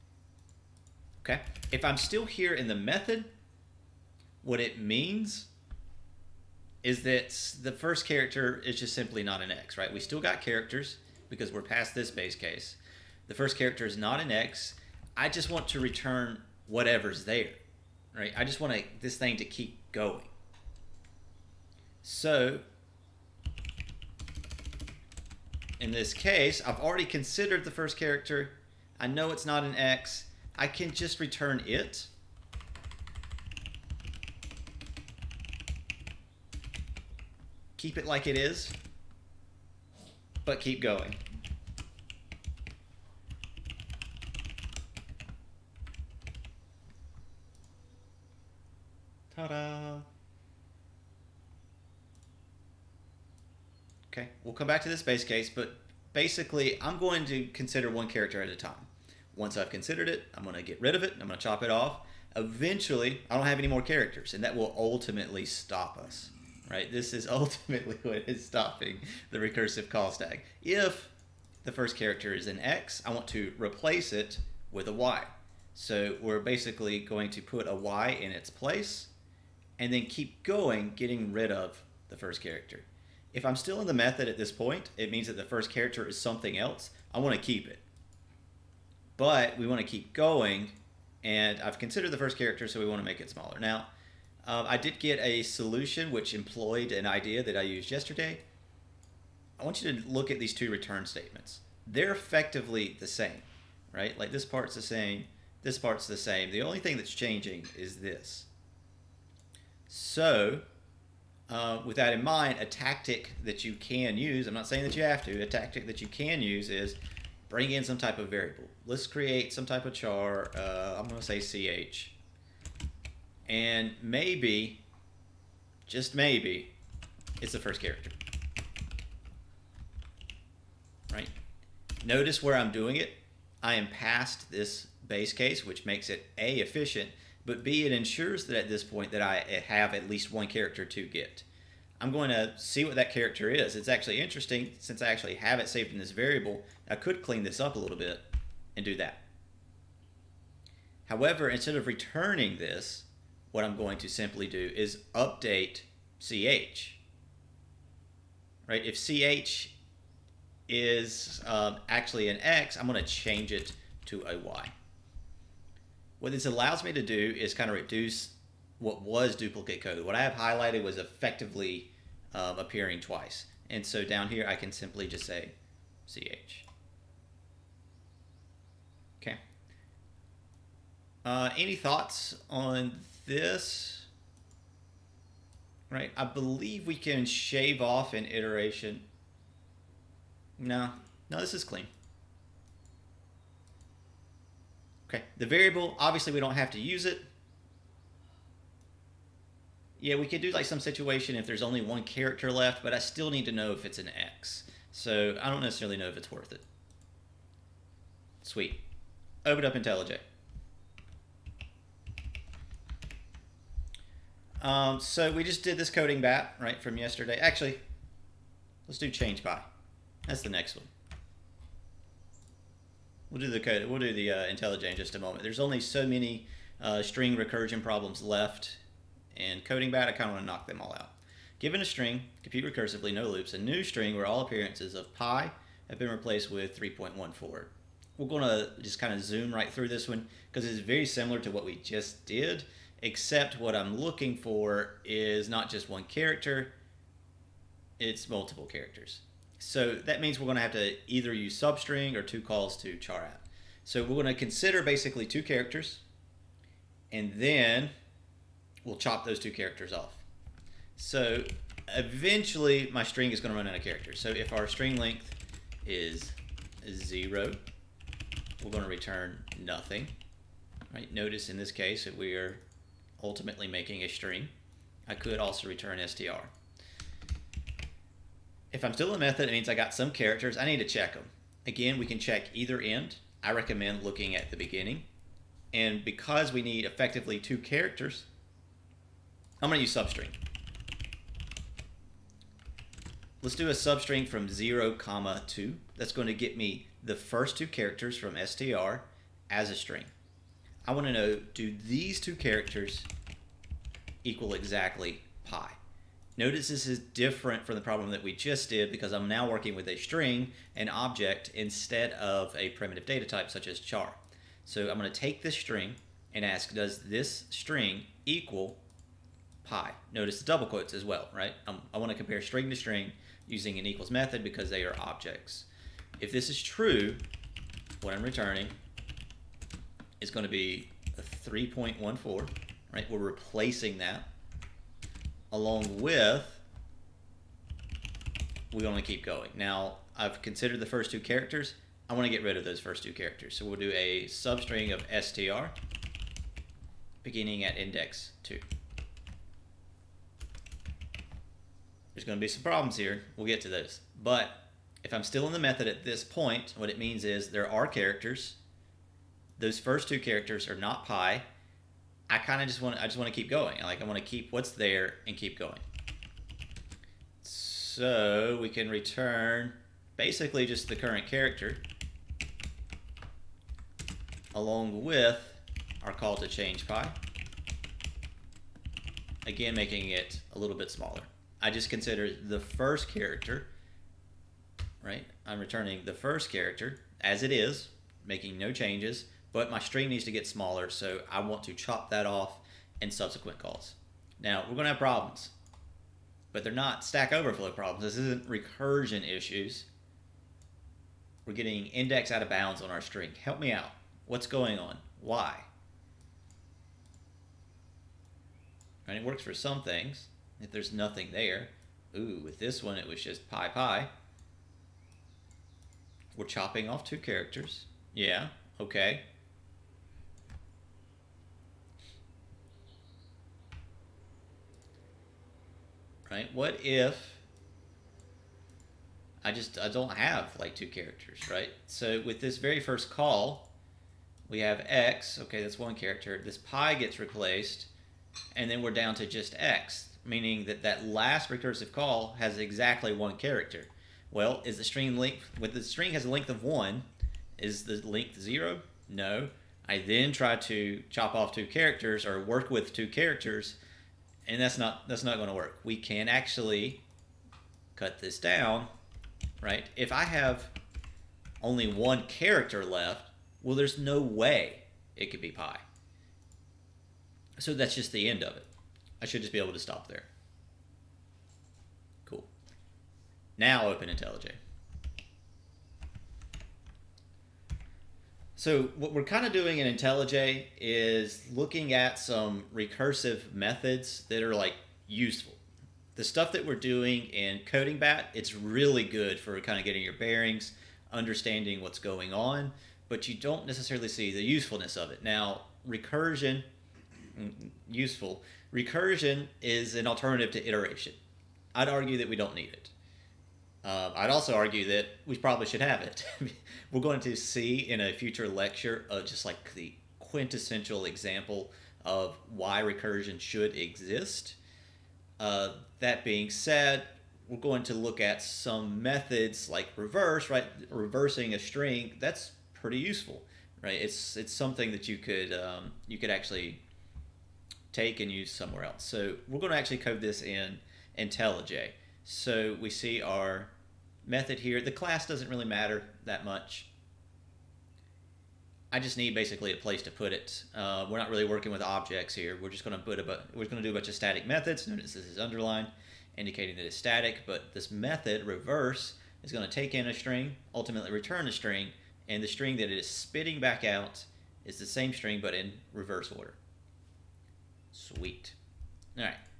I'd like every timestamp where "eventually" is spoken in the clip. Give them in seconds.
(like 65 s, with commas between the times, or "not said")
62 s, 261 s.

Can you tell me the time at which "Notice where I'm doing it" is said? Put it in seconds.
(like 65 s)
132 s.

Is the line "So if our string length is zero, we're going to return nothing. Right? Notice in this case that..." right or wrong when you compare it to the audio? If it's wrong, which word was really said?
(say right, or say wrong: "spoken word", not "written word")
right.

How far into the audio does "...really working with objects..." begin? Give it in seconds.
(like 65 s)
541 s.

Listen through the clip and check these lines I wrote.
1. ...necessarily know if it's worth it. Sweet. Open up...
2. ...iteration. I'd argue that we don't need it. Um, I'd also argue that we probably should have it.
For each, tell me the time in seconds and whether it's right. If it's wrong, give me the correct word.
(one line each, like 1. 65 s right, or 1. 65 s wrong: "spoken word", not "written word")
1. 205 s right
2. 500 s right.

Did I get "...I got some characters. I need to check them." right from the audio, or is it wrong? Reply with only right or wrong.
right.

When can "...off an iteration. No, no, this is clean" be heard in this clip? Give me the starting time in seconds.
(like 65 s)
187 s.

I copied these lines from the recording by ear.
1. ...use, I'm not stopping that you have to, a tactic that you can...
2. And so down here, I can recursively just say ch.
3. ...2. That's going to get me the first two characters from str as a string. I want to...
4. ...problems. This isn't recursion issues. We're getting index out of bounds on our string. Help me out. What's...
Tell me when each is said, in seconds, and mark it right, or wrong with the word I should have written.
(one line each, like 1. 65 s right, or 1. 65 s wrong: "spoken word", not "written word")
1. 114 s wrong: "saying", not "stopping"
2. 173 s wrong: "simply", not "recursively"
3. 295 s right
4. 397 s right.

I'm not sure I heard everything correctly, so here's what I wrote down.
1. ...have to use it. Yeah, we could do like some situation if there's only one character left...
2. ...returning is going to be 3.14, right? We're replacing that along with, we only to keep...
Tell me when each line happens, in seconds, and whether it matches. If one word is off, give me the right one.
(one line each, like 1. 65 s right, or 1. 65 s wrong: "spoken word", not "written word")
1. 196 s right
2. 328 s right.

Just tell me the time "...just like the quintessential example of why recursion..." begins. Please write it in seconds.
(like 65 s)
509 s.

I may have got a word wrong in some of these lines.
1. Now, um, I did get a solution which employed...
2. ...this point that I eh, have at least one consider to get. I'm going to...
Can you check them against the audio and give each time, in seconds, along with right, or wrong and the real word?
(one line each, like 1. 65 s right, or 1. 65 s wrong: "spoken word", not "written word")
1. 93 s right
2. 138 s wrong: "character", not "consider".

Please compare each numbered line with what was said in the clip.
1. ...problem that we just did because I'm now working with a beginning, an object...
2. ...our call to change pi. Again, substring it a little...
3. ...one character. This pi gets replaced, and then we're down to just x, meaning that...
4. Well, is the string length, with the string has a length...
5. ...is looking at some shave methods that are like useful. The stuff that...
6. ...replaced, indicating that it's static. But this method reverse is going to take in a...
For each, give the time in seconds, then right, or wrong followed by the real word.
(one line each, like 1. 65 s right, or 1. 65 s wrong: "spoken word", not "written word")
1. 307 s wrong: "string", not "beginning"
2. 376 s wrong: "making", not "substring"
3. 435 s right
4. 444 s right
5. 480 s wrong: "recursive", not "shave"
6. 545 s wrong: "underlined", not "replaced".